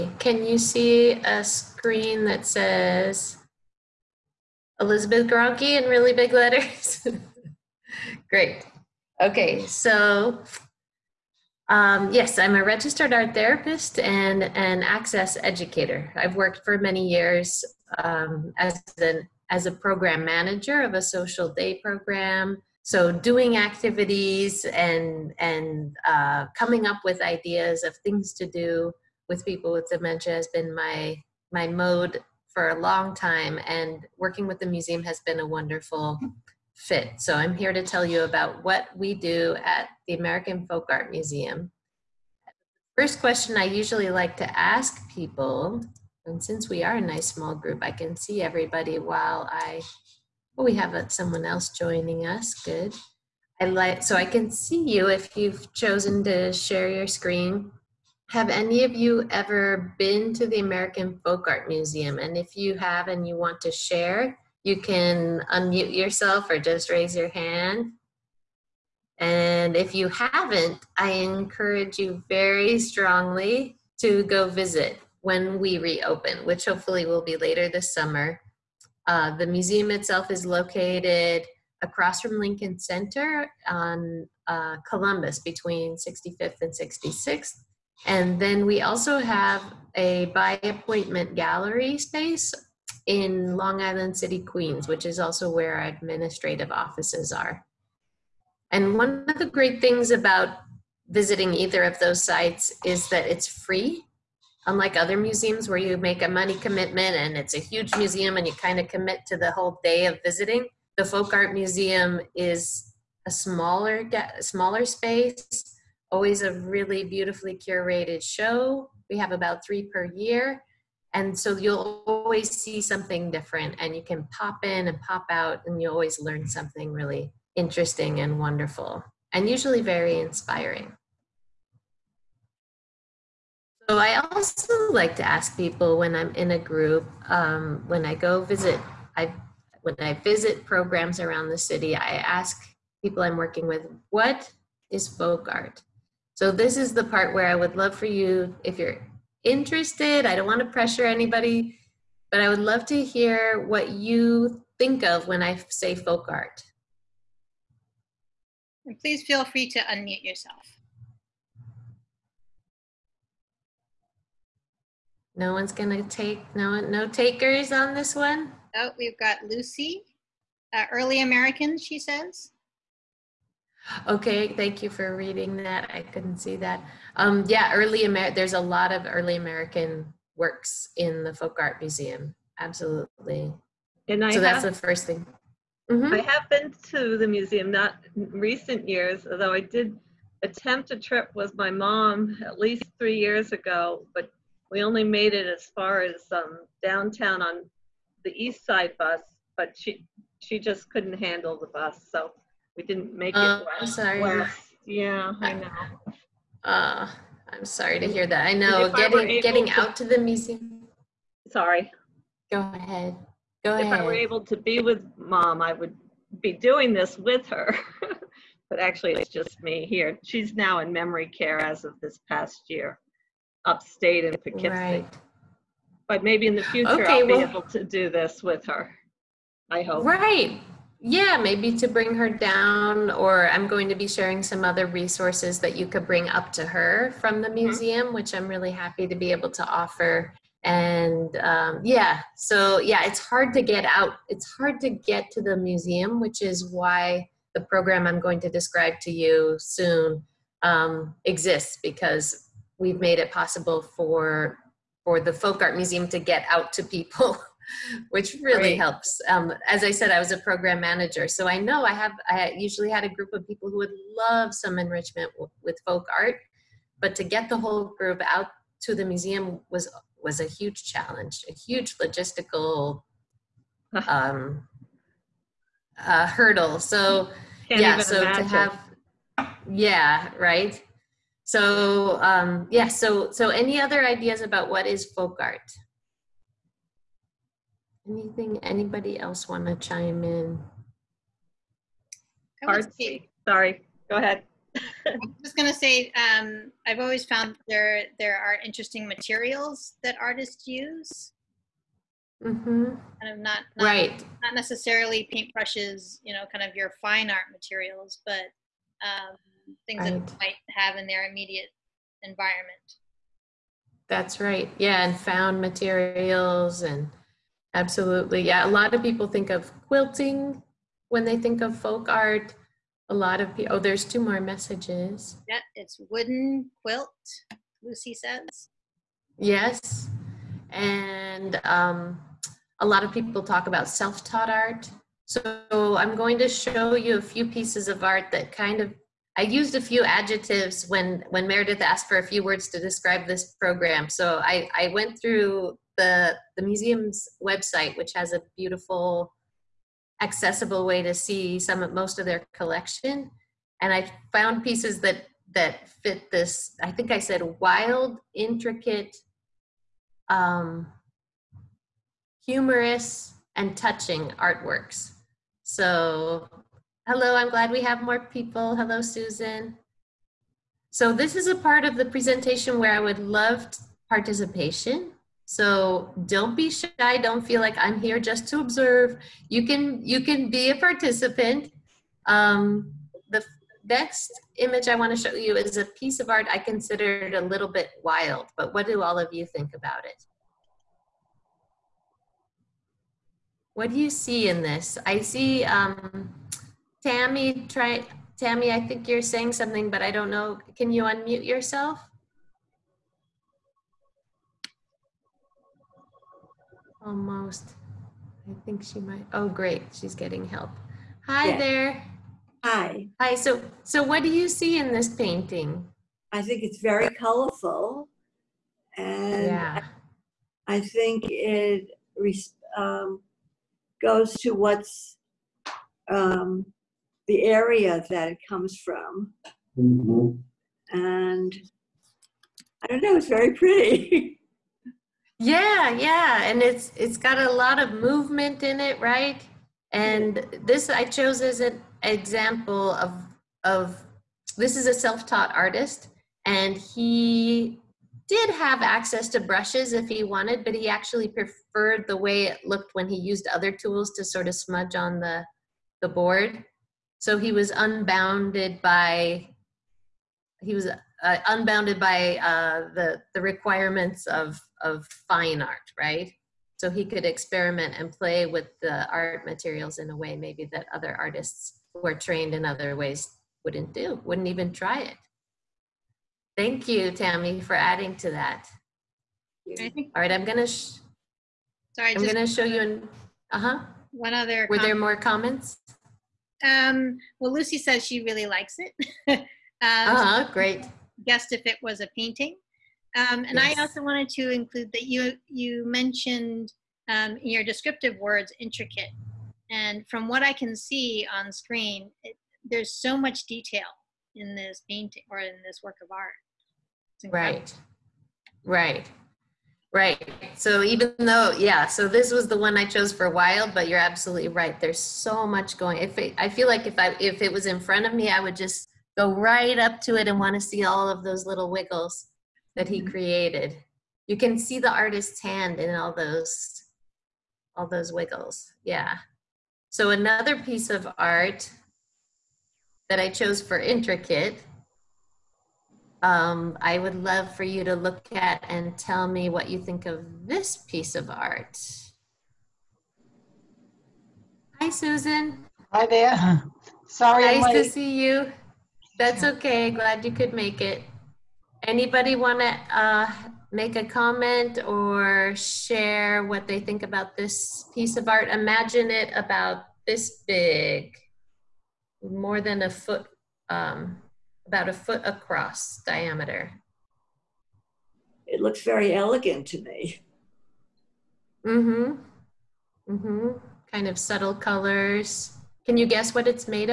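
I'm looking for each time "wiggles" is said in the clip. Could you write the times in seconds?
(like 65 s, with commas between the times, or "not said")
521 s, 528 s.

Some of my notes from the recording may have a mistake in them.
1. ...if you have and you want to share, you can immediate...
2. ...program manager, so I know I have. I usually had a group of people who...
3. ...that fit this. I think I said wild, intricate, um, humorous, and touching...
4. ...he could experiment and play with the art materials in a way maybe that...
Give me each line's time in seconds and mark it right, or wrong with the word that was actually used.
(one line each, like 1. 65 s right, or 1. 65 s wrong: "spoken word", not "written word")
1. 62 s wrong: "unmute", not "immediate"
2. 260 s right
3. 355 s right
4. 466 s right.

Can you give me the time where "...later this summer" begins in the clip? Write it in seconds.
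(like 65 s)
77 s.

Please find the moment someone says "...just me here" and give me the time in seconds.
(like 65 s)
219 s.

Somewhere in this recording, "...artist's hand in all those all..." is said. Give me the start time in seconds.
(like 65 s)
524 s.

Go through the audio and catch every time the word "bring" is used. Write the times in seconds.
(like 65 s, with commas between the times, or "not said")
231 s, 236 s.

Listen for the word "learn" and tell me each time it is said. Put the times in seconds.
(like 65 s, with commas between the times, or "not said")
126 s.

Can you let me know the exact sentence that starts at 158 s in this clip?
And please feel free to unmute yourself.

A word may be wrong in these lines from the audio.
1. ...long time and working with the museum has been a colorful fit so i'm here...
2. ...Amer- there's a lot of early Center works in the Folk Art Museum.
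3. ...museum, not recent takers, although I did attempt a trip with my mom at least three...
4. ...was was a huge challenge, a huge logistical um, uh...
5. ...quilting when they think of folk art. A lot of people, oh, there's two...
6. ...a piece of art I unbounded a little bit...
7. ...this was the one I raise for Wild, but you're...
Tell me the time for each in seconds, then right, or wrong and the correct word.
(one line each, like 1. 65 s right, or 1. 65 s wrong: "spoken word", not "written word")
1. 32 s wrong: "wonderful", not "colorful"
2. 178 s wrong: "American", not "Center"
3. 187 s wrong: "years", not "takers"
4. 269 s right
5. 319 s right
6. 385 s wrong: "considered", not "unbounded"
7. 512 s wrong: "chose", not "raise".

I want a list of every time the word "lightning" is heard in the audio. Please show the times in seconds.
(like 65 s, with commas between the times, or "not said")
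not said.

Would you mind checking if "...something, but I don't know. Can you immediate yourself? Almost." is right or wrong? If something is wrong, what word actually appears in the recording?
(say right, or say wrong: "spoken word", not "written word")
wrong: "unmute", not "immediate".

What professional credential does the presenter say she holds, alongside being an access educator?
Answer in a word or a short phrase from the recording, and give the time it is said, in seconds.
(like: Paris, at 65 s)
registered art therapist, at 12 s.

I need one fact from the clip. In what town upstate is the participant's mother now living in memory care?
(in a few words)
Poughkeepsie.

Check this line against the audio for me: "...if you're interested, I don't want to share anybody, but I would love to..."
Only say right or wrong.
wrong.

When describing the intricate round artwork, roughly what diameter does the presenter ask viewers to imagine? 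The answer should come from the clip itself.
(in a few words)
about a foot.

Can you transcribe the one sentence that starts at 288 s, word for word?
Anything, anybody else want to chime in?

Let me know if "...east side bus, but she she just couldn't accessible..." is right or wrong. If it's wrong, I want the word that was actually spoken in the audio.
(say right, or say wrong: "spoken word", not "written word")
wrong: "handle", not "accessible".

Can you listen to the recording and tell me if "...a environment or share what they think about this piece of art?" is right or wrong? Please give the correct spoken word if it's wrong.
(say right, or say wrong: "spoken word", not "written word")
wrong: "comment", not "environment".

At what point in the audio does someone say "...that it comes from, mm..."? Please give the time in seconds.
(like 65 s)
428 s.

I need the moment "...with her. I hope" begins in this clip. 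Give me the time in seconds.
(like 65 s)
228 s.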